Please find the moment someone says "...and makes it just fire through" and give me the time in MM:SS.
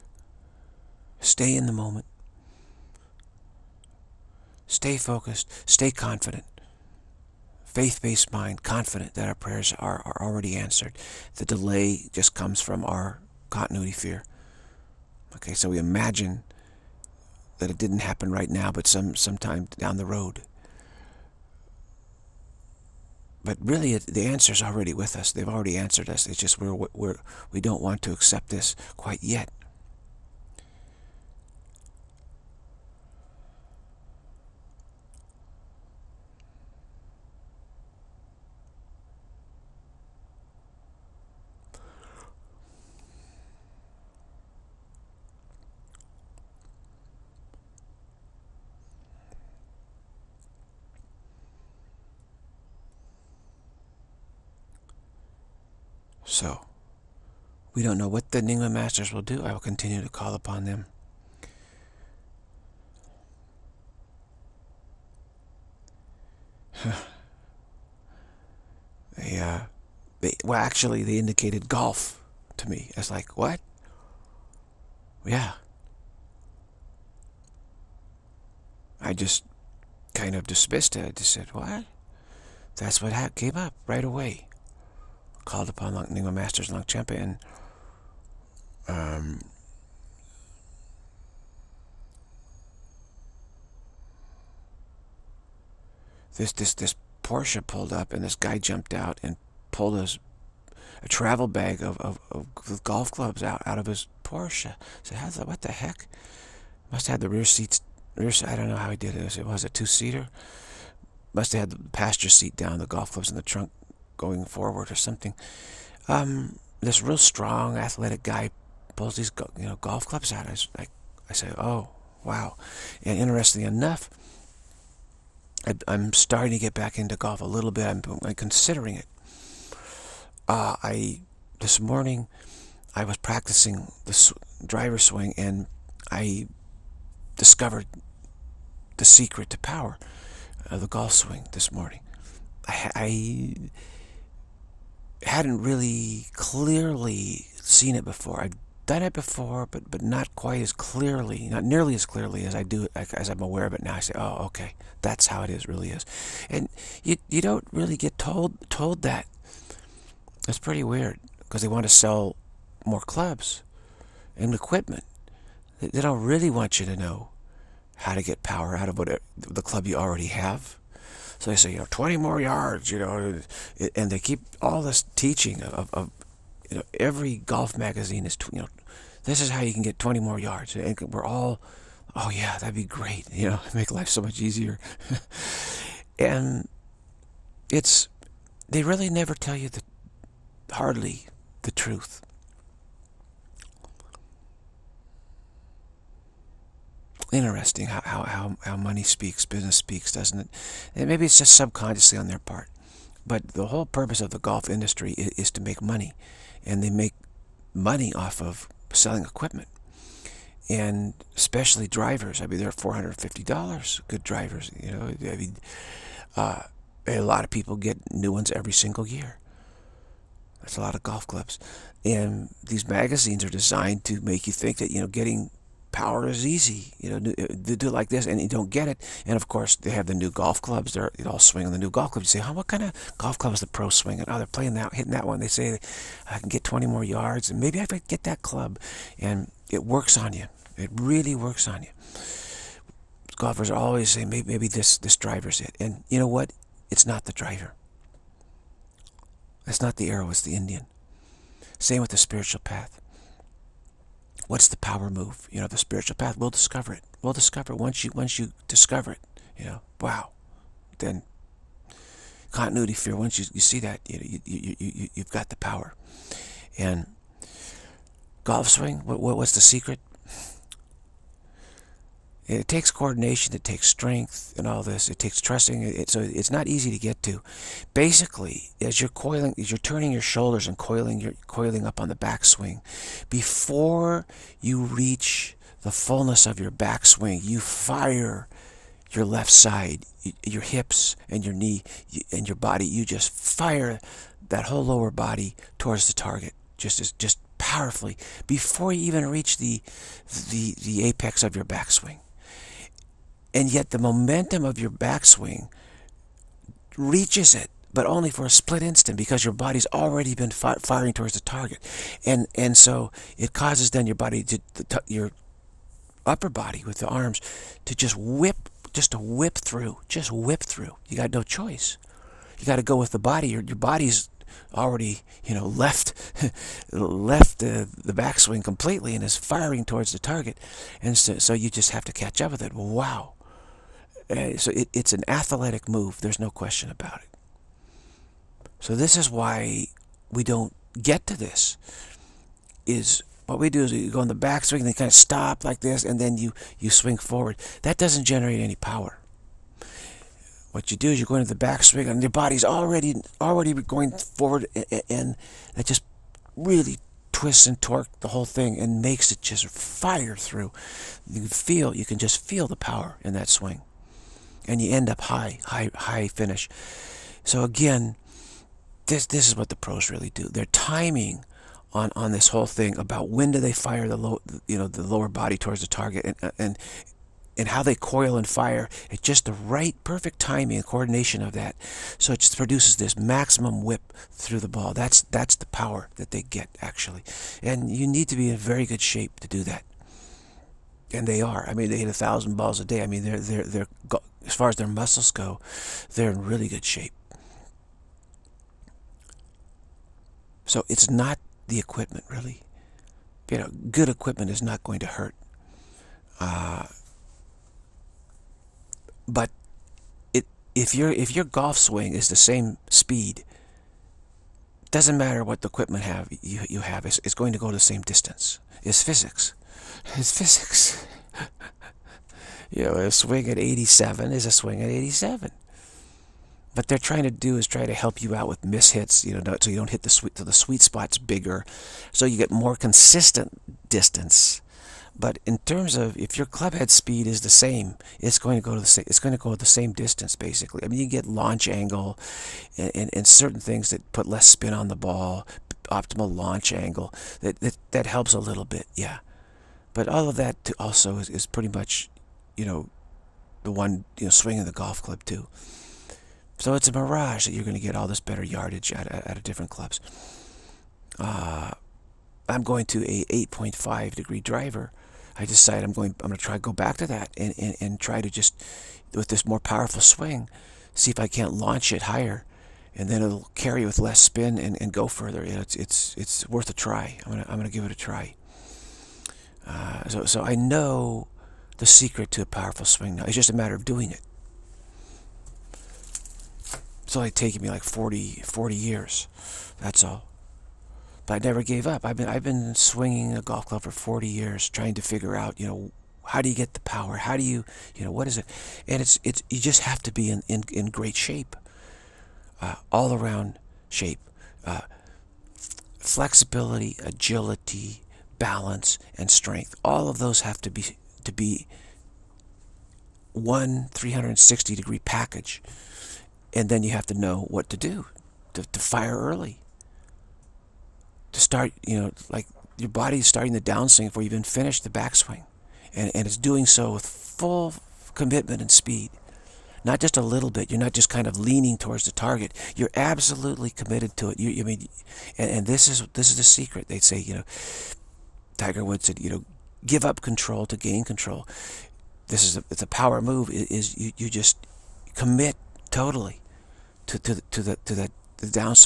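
05:58.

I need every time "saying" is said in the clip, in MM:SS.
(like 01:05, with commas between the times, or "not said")
04:04.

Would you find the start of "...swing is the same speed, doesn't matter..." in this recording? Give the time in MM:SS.
06:51.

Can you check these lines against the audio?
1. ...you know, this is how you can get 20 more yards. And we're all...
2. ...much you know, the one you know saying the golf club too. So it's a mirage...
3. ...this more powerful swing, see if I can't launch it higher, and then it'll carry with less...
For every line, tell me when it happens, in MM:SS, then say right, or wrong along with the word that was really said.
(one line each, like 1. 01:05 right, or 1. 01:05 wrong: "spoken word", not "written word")
1. 02:58 right
2. 07:31 wrong: "swinging", not "saying"
3. 07:49 right.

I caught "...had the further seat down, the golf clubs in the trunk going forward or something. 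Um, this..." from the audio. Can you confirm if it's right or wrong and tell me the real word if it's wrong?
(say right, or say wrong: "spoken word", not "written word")
wrong: "passenger", not "further".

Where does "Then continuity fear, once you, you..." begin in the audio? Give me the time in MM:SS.
04:20.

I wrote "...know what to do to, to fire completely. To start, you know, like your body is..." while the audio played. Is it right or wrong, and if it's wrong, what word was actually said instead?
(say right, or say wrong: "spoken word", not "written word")
wrong: "early", not "completely".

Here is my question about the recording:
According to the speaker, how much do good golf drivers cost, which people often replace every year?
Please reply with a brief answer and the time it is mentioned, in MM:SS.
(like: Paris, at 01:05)
$450, at 03:32.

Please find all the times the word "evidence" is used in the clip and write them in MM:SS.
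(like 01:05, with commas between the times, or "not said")
not said.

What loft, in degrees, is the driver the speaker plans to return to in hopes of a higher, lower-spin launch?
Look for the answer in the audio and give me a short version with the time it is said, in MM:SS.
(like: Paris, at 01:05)
8.5, at 07:43.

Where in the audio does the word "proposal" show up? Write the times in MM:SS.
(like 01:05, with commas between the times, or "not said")
not said.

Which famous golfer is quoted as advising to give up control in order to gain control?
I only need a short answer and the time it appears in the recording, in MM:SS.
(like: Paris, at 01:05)
Tiger Woods, at 08:58.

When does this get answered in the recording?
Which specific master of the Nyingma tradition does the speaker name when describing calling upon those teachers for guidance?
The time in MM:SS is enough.
01:26.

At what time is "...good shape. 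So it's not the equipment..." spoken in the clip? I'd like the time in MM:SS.
06:36.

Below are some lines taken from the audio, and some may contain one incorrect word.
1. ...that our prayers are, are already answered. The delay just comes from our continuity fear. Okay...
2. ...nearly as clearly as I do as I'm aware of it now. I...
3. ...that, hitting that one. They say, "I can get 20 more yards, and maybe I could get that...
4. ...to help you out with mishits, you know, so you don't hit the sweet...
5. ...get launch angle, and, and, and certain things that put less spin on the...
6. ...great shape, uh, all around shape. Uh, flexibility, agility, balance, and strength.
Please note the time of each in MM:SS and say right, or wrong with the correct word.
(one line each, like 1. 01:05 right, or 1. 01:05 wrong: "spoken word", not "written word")
1. 00:09 right
2. 02:31 right
3. 03:54 right
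4. 07:07 right
5. 07:21 right
6. 08:20 right.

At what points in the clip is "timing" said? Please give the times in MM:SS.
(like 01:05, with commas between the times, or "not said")
06:10, 06:20.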